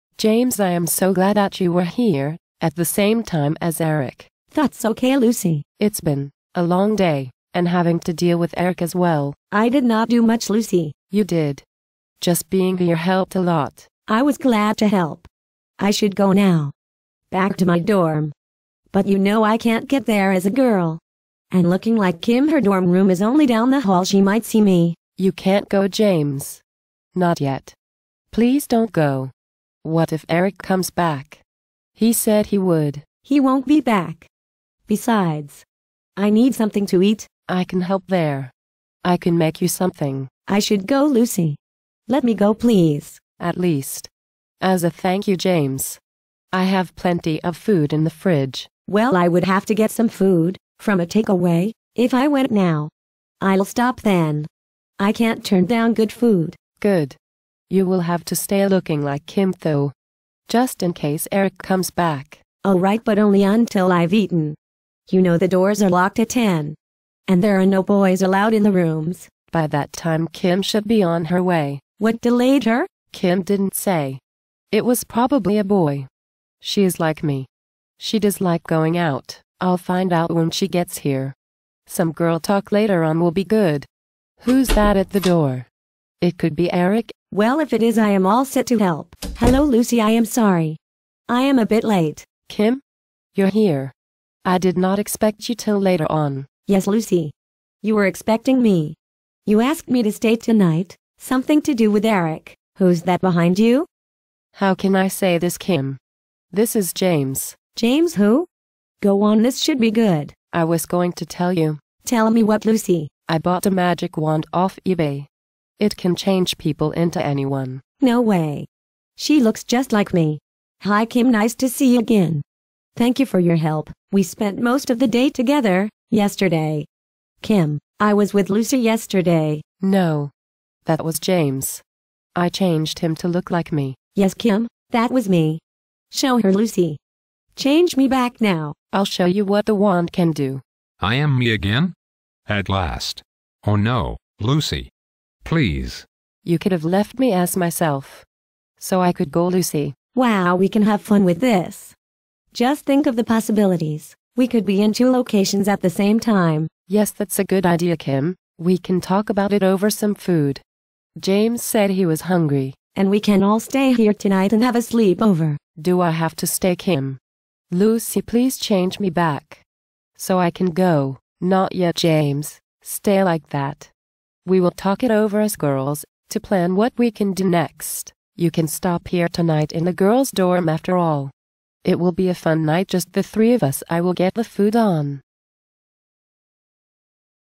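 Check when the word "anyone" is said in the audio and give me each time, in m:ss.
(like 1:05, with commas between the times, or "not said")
1:57.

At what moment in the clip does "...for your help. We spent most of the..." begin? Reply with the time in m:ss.
2:03.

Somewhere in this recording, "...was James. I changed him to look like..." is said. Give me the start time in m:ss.
2:11.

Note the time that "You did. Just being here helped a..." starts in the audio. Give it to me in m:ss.
0:11.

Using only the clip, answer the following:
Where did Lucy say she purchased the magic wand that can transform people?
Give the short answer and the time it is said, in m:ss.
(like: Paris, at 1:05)
eBay, at 1:54.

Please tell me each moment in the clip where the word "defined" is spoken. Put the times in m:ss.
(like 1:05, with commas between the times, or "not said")
not said.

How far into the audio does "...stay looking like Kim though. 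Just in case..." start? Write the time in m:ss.
0:58.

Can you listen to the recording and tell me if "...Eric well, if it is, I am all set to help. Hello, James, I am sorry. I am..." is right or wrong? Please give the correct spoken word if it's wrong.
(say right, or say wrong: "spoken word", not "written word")
wrong: "Lucy", not "James".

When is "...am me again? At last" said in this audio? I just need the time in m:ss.
2:21.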